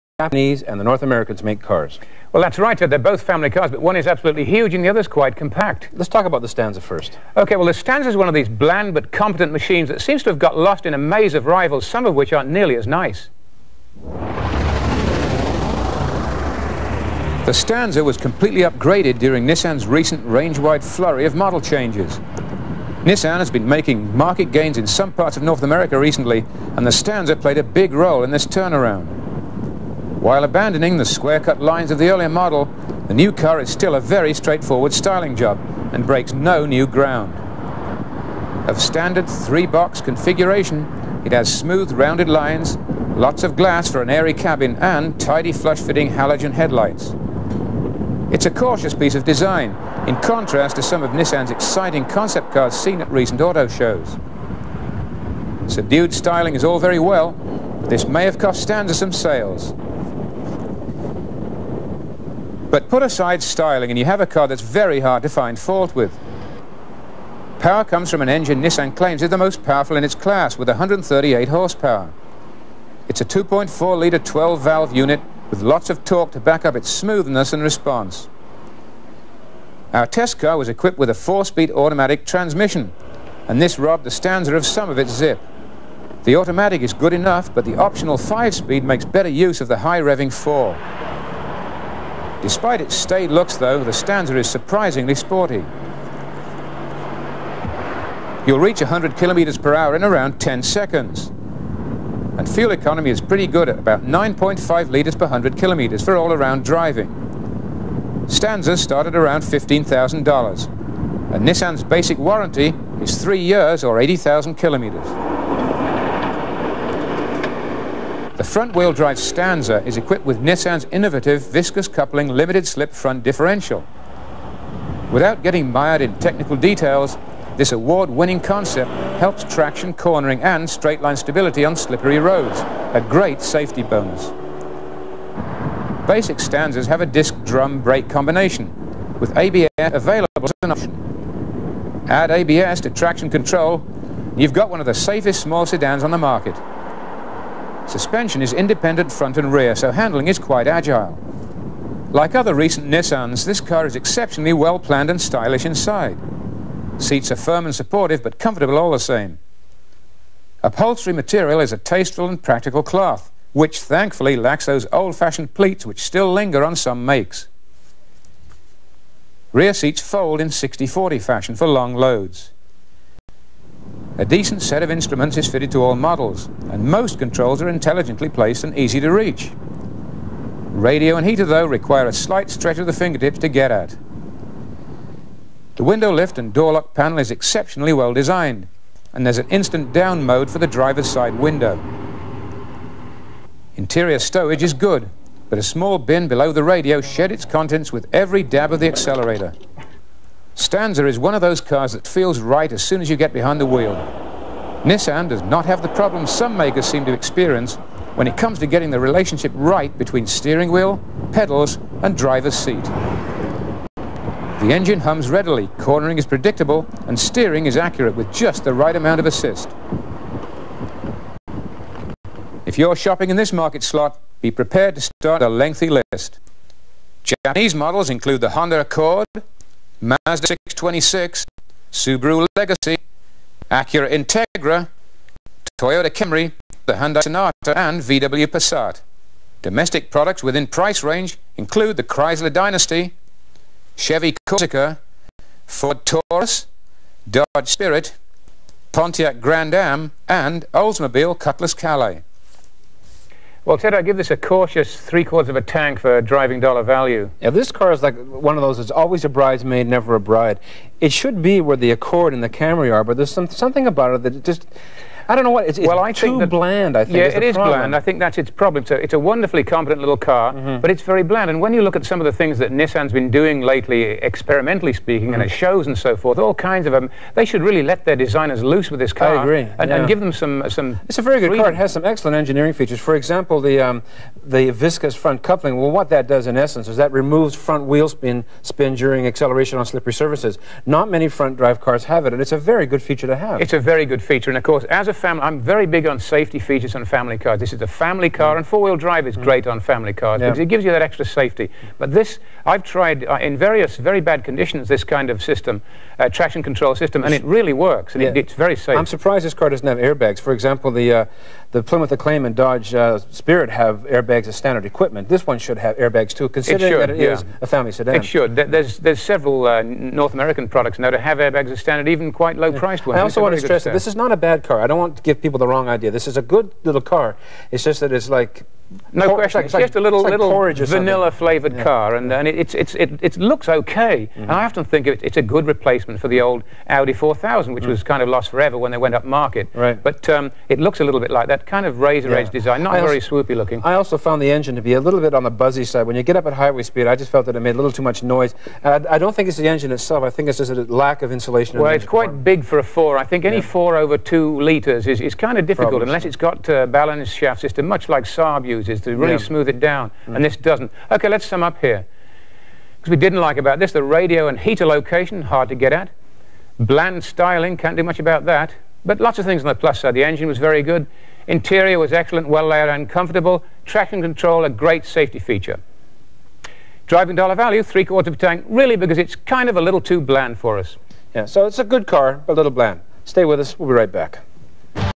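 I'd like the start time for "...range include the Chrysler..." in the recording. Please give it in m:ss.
4:01.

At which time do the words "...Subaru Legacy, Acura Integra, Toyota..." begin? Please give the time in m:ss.
3:51.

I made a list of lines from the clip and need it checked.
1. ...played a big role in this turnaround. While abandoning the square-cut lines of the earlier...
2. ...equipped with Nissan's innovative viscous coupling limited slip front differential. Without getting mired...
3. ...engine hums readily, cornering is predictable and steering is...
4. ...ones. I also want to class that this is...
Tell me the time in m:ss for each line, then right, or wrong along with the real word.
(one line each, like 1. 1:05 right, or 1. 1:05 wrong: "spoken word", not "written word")
1. 0:27 right
2. 1:59 right
3. 3:34 right
4. 5:23 wrong: "stress", not "class".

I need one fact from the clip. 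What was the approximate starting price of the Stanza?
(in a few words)
$15,000.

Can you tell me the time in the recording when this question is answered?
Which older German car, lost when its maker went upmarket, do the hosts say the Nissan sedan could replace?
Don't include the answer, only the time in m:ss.
5:36.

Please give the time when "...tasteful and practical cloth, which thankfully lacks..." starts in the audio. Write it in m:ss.
2:41.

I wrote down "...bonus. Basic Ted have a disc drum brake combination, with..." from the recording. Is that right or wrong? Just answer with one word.
wrong.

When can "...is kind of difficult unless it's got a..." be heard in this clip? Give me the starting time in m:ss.
5:55.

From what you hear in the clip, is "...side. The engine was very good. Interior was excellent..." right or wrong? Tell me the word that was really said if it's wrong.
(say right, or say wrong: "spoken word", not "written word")
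right.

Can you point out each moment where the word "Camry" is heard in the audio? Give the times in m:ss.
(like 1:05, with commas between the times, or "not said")
3:56, 4:22.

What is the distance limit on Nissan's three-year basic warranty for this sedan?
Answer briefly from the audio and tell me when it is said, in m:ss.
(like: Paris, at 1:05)
80,000 kilometers, at 1:53.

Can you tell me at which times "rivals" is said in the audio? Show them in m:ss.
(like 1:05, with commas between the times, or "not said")
0:11.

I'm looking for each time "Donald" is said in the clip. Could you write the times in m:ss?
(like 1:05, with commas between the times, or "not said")
not said.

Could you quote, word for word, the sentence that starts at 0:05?
Let's talk about the Stanza first.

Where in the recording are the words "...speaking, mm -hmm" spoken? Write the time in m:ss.
4:34.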